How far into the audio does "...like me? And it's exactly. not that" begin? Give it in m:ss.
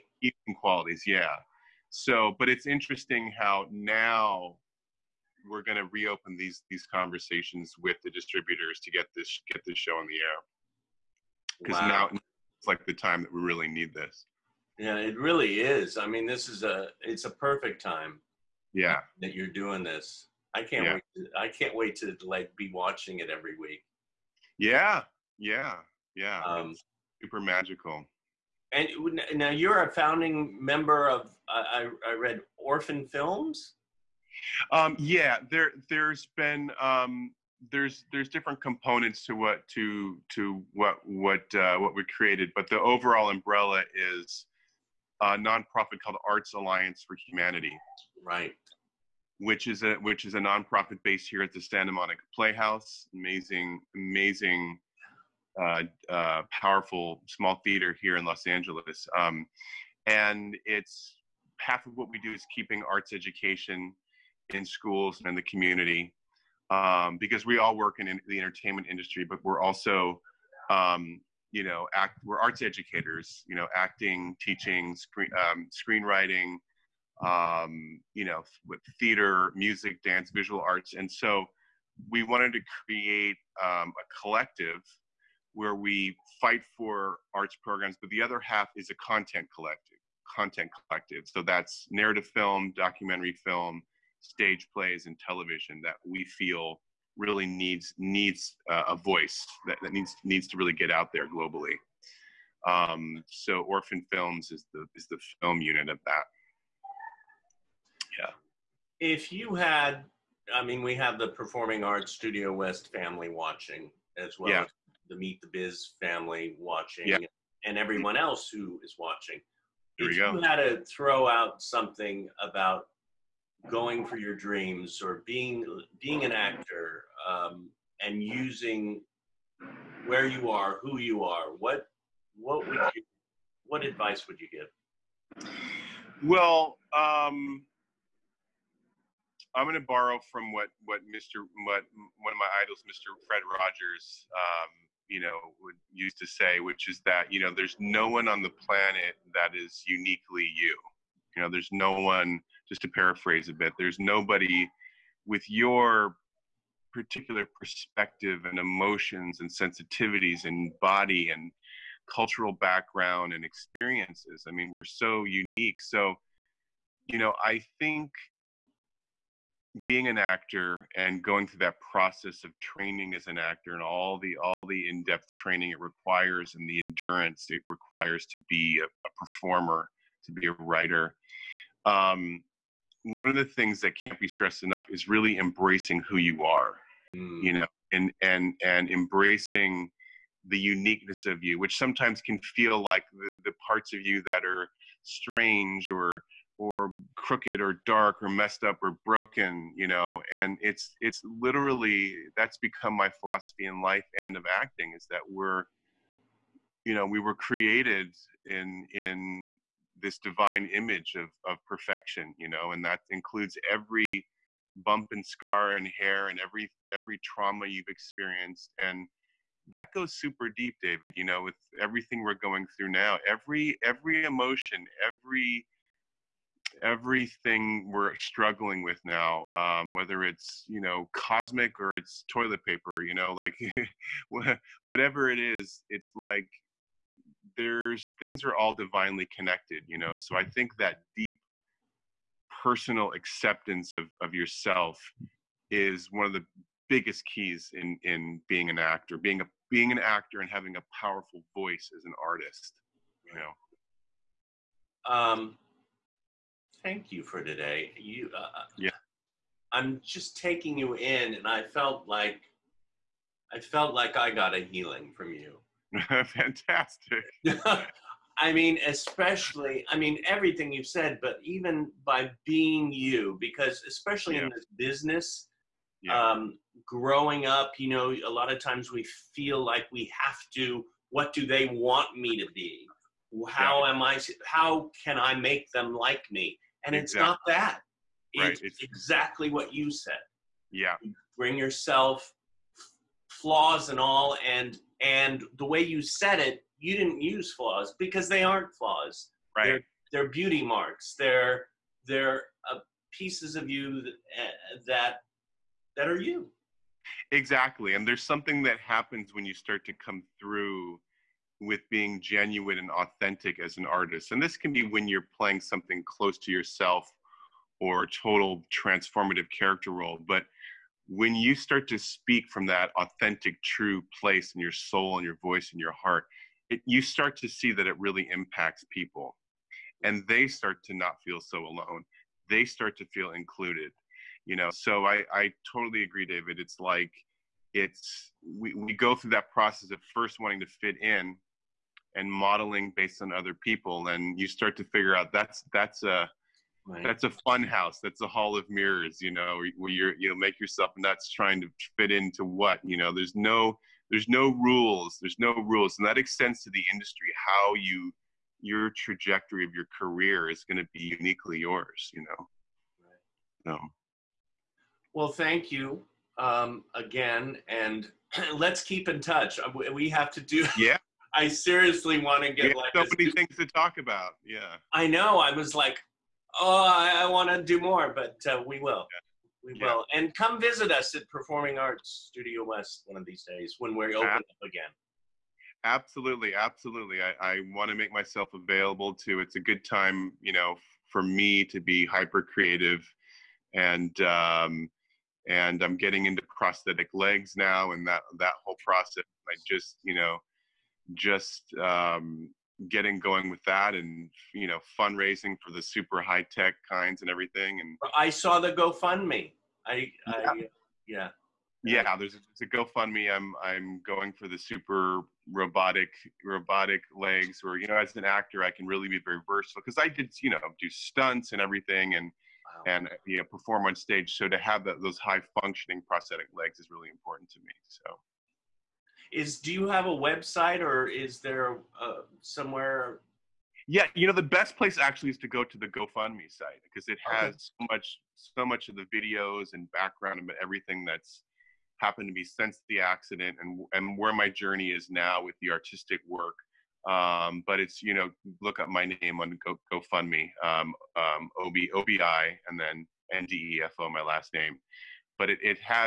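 4:45.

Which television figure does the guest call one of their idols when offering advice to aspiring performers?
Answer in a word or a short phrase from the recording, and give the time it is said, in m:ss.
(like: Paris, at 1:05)
Fred Rogers, at 2:23.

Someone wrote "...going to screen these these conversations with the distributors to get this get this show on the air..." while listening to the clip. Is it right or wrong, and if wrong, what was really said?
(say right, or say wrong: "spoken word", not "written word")
wrong: "reopen", not "screen".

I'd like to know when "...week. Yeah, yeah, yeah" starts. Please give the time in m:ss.
0:23.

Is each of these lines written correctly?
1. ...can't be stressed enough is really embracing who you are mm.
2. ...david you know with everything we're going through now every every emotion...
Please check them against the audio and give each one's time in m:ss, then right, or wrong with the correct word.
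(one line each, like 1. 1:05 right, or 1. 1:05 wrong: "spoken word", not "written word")
1. 3:03 right
2. 3:40 right.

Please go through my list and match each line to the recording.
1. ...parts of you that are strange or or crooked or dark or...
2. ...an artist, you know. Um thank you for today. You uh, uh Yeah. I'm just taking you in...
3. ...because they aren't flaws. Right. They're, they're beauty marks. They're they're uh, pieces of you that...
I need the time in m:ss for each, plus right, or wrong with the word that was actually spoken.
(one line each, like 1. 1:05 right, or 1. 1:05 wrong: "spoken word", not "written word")
1. 3:13 right
2. 4:12 right
3. 4:57 right.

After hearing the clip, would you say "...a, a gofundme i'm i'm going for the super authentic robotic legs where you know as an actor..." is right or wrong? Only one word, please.
wrong.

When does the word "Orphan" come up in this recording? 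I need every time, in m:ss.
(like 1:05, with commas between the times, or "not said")
0:32, 1:43.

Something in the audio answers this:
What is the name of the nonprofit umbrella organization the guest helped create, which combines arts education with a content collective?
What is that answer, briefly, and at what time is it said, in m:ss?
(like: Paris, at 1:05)
Arts Alliance for Humanity, at 0:46.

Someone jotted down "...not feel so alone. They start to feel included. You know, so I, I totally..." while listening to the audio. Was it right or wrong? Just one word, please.
right.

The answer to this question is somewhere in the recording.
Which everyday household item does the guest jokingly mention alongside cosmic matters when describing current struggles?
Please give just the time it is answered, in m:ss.
3:52.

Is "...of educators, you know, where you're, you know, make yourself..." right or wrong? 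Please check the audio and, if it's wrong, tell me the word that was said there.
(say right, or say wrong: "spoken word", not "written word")
wrong: "mirrors", not "educators".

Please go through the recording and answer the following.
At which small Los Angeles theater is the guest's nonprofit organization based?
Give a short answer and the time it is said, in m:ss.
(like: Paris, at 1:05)
Santa Monica Playhouse, at 0:51.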